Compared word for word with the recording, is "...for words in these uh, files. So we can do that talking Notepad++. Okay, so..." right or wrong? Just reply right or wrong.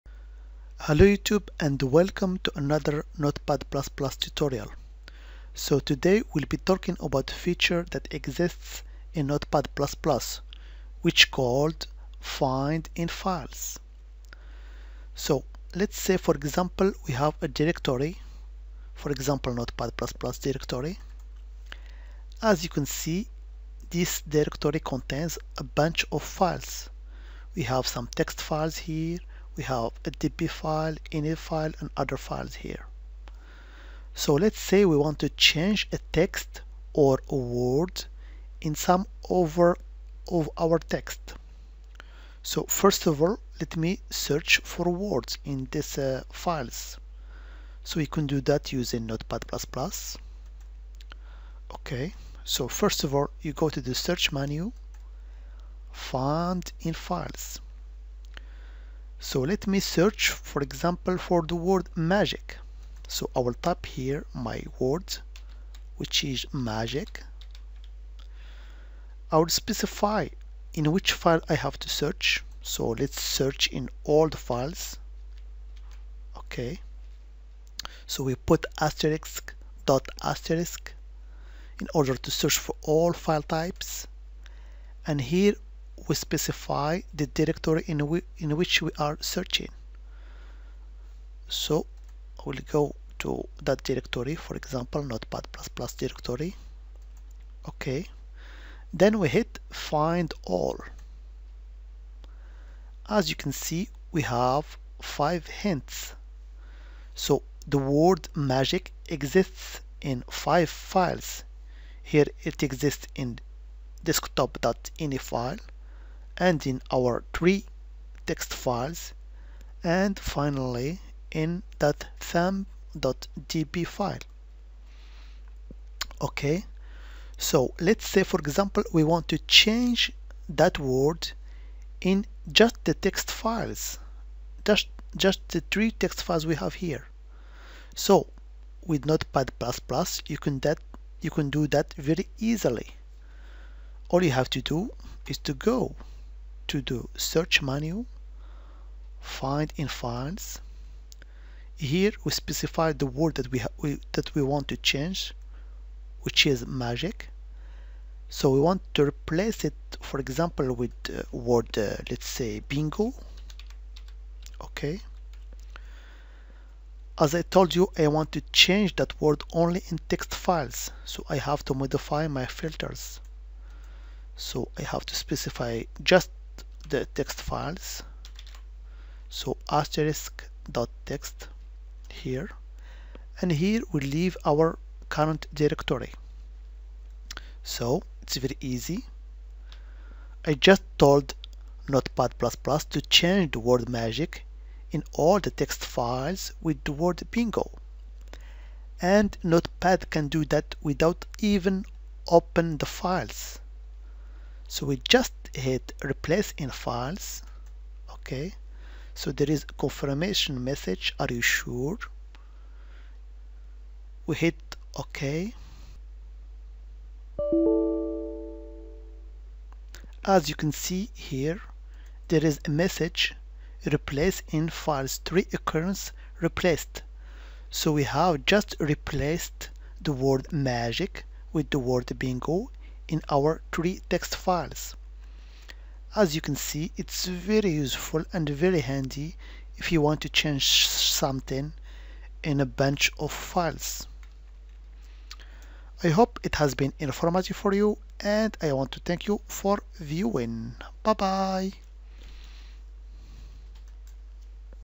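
wrong.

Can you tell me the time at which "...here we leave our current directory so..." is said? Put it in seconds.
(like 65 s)
183 s.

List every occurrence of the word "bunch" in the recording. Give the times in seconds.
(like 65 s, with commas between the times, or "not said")
25 s, 242 s.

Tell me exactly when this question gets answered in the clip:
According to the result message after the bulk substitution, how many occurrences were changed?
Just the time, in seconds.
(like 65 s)
225 s.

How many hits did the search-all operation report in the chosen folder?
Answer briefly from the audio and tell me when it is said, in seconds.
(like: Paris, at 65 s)
5, at 105 s.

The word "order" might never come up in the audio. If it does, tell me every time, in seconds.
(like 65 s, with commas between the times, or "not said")
81 s.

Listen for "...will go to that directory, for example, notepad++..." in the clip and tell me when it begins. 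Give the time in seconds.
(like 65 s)
92 s.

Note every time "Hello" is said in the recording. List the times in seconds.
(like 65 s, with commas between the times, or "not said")
0 s.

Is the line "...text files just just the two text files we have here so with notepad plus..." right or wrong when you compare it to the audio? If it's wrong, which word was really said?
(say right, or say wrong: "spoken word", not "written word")
wrong: "three", not "two".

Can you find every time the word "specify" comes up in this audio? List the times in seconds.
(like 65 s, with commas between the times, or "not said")
69 s, 86 s, 152 s, 175 s.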